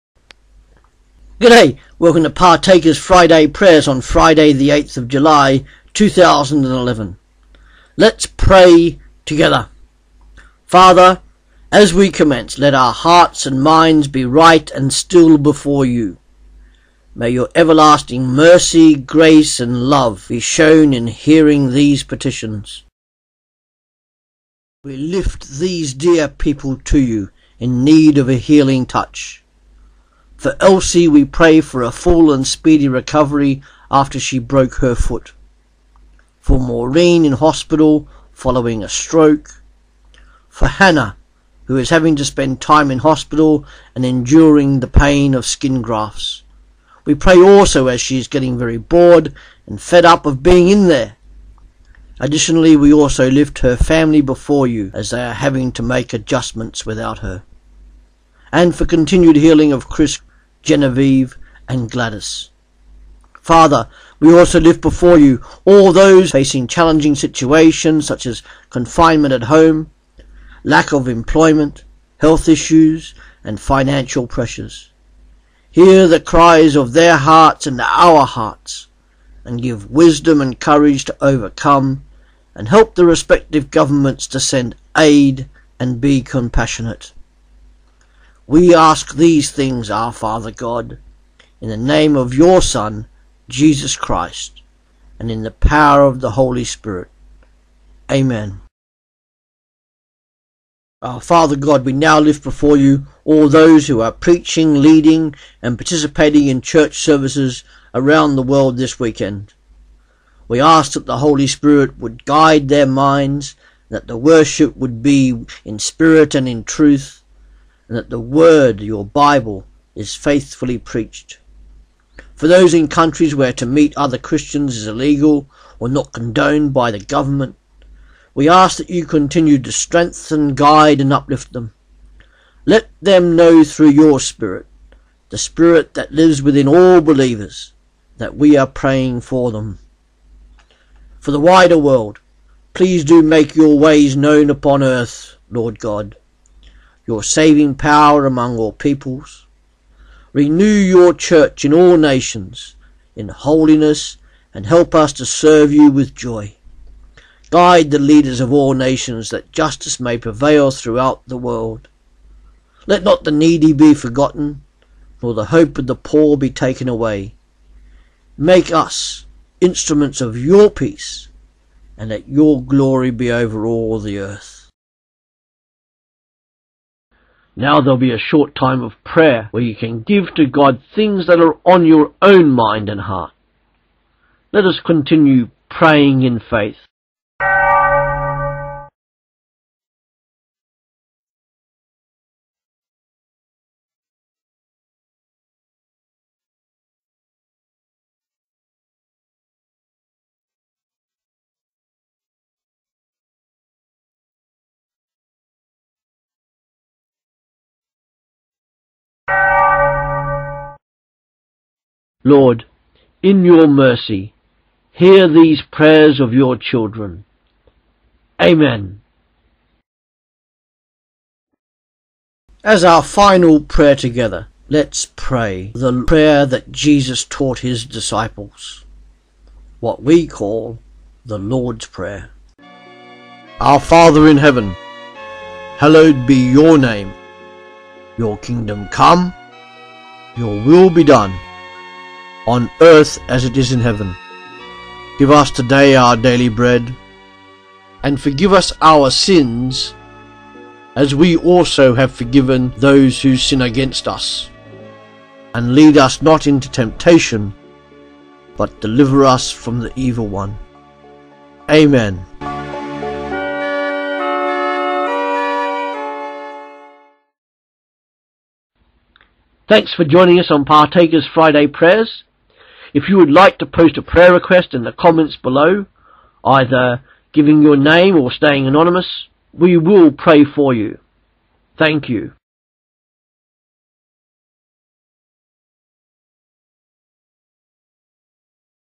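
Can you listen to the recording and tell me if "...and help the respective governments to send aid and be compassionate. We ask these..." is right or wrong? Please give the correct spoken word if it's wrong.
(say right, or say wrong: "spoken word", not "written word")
right.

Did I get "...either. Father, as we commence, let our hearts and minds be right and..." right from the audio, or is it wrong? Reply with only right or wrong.
wrong.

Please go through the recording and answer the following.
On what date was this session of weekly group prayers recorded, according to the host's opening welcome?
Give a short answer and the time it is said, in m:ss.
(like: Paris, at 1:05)
8 July 2011, at 0:04.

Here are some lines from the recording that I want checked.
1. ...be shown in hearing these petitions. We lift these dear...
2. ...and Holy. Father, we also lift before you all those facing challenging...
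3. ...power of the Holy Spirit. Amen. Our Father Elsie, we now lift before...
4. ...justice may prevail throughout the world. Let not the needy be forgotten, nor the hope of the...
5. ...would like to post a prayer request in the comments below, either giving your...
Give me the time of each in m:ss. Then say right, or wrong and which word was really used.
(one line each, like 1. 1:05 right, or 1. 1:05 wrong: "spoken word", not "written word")
1. 0:20 right
2. 1:01 wrong: "Gladys", not "Holy"
3. 1:35 wrong: "God", not "Elsie"
4. 2:39 right
5. 4:33 right.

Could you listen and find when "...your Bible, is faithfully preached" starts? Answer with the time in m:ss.
1:58.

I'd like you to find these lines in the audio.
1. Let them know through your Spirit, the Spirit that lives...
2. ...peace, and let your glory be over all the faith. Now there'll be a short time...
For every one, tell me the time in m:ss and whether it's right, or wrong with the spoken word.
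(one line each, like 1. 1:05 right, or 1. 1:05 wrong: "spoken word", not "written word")
1. 2:12 right
2. 2:50 wrong: "earth", not "faith".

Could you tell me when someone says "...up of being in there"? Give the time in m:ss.
0:50.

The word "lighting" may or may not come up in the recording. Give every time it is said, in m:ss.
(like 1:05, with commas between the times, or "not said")
not said.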